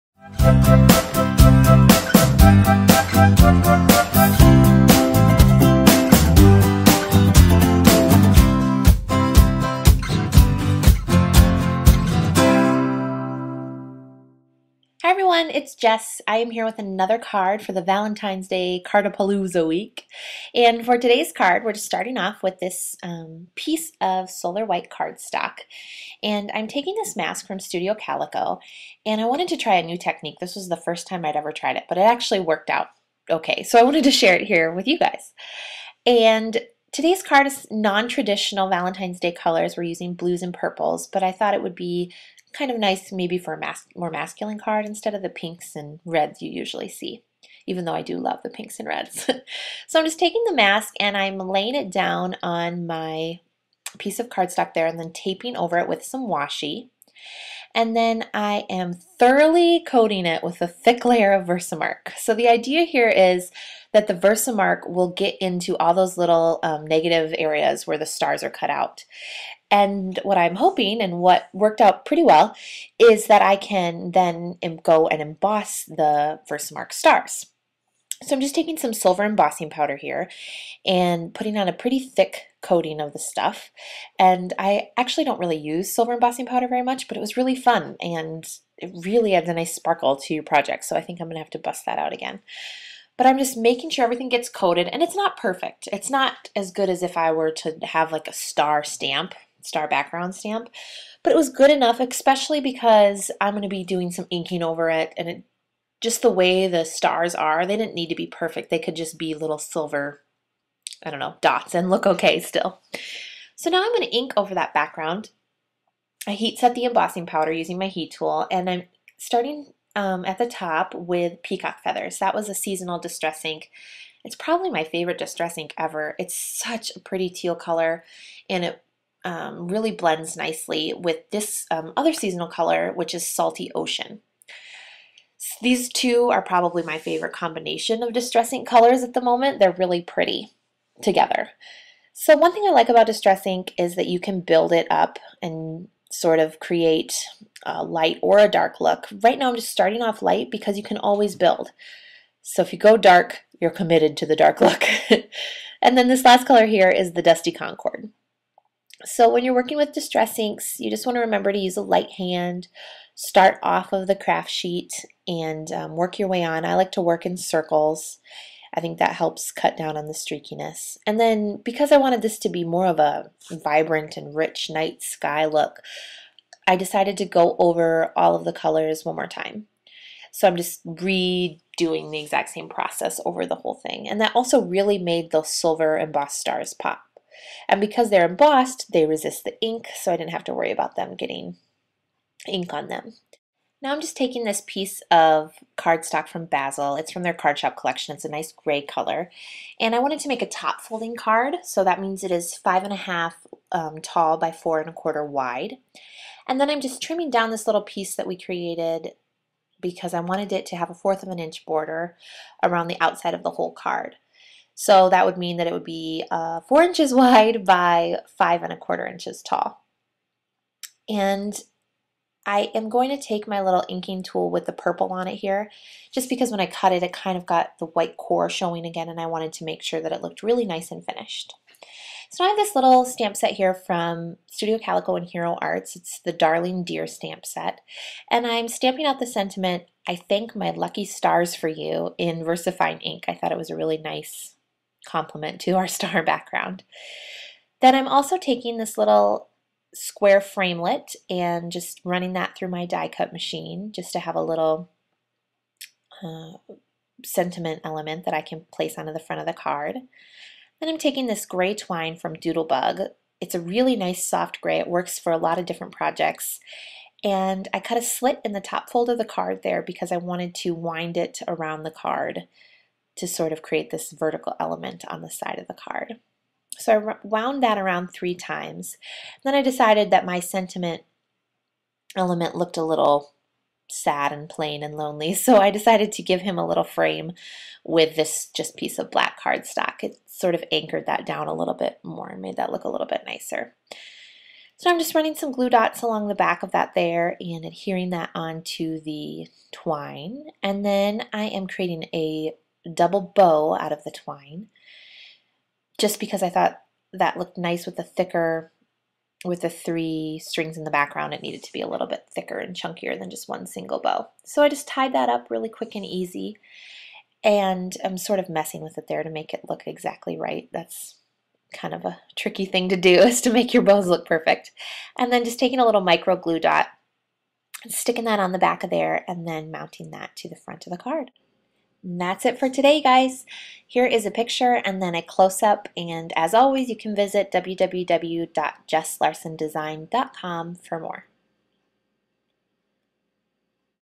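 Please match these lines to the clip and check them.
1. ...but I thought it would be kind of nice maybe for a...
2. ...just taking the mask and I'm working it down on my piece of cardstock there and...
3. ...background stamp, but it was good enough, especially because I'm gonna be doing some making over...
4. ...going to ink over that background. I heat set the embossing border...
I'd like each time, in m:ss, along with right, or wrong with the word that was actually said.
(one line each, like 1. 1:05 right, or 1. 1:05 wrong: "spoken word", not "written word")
1. 0:41 right
2. 0:50 wrong: "laying", not "working"
3. 1:39 wrong: "inking", not "making"
4. 1:53 wrong: "powder", not "border".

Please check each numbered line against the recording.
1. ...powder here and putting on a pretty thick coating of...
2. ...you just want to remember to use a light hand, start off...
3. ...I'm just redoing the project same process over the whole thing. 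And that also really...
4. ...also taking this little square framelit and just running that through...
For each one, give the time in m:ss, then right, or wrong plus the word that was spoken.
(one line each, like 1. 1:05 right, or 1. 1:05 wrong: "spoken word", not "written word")
1. 1:19 right
2. 2:40 right
3. 3:00 wrong: "exact", not "project"
4. 4:08 right.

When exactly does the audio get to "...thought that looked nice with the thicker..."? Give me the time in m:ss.
5:06.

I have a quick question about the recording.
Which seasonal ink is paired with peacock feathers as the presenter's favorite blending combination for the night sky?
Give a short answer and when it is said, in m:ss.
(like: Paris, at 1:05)
Salty Ocean, at 2:13.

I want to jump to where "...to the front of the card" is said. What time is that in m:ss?
5:30.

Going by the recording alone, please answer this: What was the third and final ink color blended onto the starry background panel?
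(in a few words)
Dusty Concord.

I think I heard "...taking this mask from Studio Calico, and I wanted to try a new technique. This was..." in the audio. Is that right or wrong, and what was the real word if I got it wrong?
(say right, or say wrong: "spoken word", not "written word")
right.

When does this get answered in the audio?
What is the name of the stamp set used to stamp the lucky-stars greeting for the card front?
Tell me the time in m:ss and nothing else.
3:56.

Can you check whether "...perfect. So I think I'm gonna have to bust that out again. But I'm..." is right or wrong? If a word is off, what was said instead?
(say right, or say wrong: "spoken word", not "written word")
wrong: "project", not "perfect".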